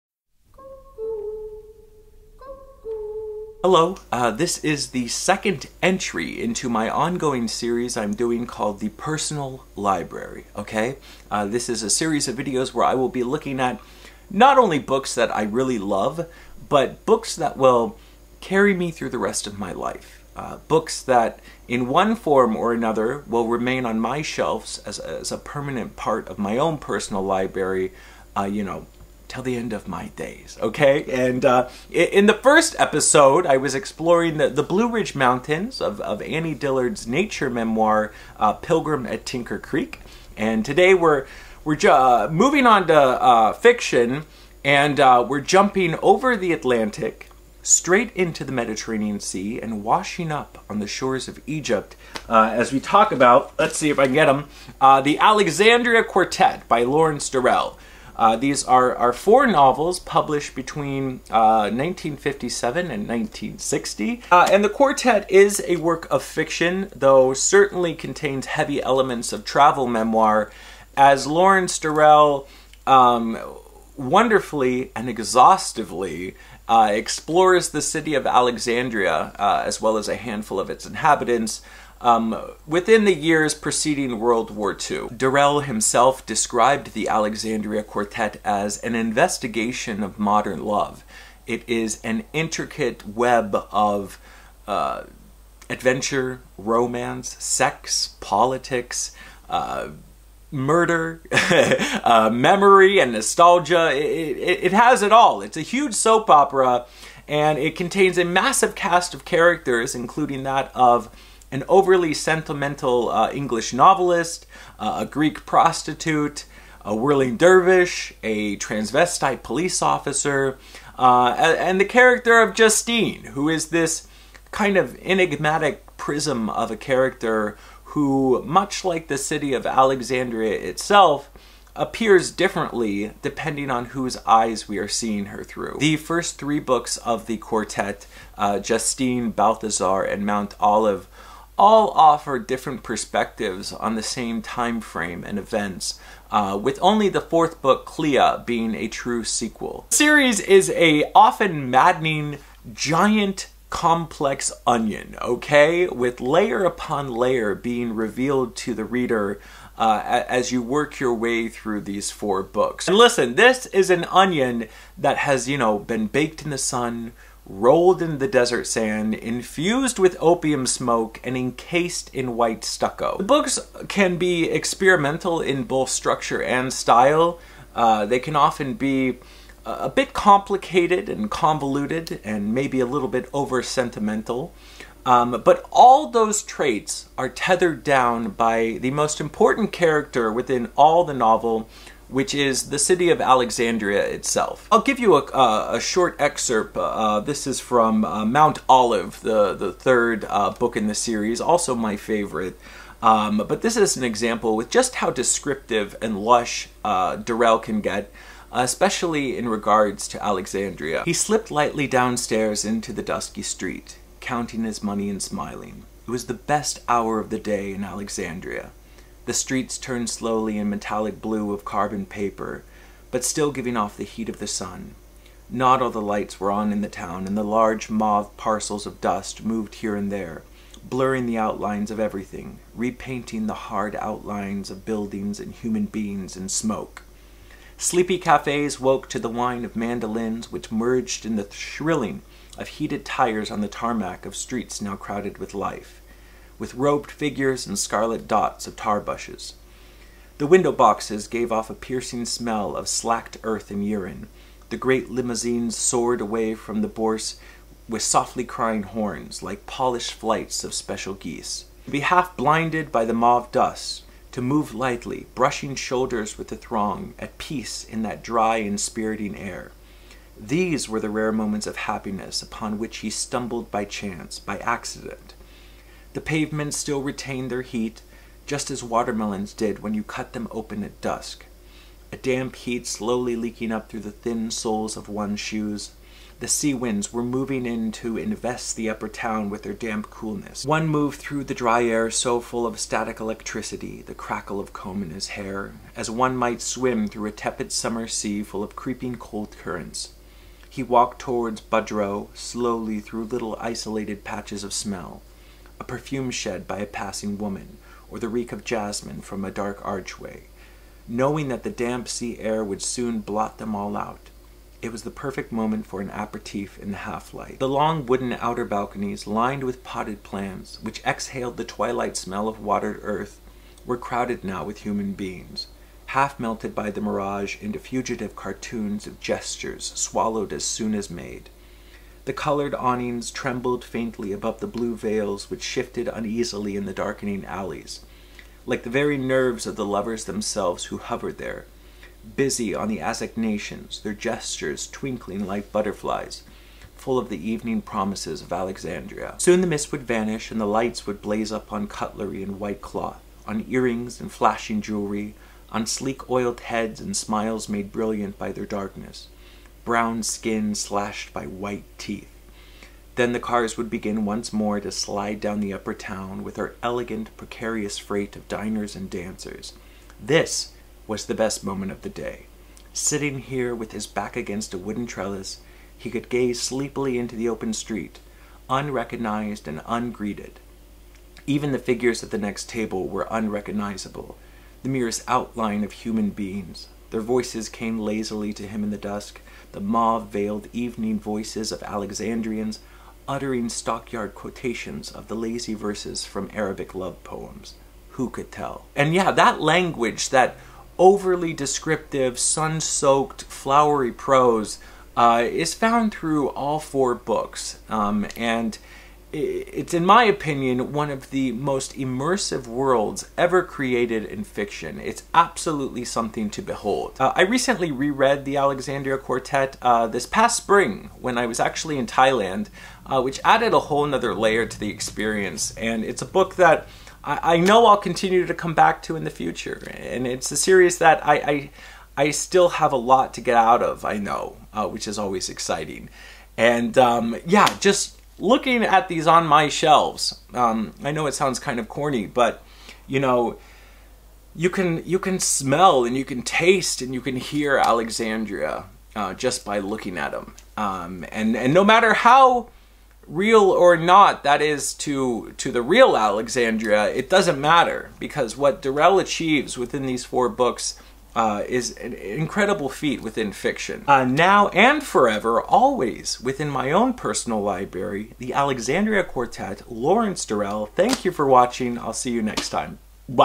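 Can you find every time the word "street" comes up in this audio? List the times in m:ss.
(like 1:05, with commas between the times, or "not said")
3:33, 3:39, 4:04, 6:17.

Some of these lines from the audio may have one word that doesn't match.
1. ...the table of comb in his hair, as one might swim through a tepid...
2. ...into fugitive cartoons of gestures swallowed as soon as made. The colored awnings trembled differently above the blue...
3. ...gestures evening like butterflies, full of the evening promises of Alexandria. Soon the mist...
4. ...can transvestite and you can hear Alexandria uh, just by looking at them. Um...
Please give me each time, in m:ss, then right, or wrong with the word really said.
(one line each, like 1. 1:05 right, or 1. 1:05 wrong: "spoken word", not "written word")
1. 4:54 wrong: "crackle", not "table"
2. 5:27 wrong: "faintly", not "differently"
3. 5:44 wrong: "twinkling", not "evening"
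4. 7:26 wrong: "taste", not "transvestite".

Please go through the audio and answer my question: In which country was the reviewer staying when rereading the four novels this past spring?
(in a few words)
Thailand.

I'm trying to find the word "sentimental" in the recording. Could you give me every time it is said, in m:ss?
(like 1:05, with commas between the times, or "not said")
1:52, 3:03.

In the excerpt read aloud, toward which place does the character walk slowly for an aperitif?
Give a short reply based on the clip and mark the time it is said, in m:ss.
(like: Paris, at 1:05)
Baudrot, at 5:01.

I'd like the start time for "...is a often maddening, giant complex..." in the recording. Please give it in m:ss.
2:30.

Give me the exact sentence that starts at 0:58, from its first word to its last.
Uh, these are, are four novels published between uh, 1957 and 1960.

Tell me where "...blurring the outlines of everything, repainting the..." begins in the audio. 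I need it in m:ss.
3:50.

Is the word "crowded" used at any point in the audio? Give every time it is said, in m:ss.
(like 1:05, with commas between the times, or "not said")
4:04, 5:23.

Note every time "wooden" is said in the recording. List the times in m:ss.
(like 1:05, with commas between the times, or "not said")
5:18, 6:14.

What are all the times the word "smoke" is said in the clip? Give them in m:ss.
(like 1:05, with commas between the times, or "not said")
2:50, 3:56.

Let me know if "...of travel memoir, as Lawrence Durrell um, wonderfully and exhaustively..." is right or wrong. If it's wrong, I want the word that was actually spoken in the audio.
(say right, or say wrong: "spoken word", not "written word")
right.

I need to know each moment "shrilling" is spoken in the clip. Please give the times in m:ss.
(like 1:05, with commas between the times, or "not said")
4:01.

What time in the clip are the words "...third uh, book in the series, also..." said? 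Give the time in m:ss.
3:19.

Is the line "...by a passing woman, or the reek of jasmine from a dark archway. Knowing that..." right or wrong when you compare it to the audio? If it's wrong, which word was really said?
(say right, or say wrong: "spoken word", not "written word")
right.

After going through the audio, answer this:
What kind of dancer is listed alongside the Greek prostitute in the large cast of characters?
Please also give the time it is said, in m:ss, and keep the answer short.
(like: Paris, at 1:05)
whirling dervish, at 1:56.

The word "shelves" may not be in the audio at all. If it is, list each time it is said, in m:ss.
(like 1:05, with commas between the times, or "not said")
0:24, 7:19.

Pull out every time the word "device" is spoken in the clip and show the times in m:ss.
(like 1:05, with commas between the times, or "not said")
not said.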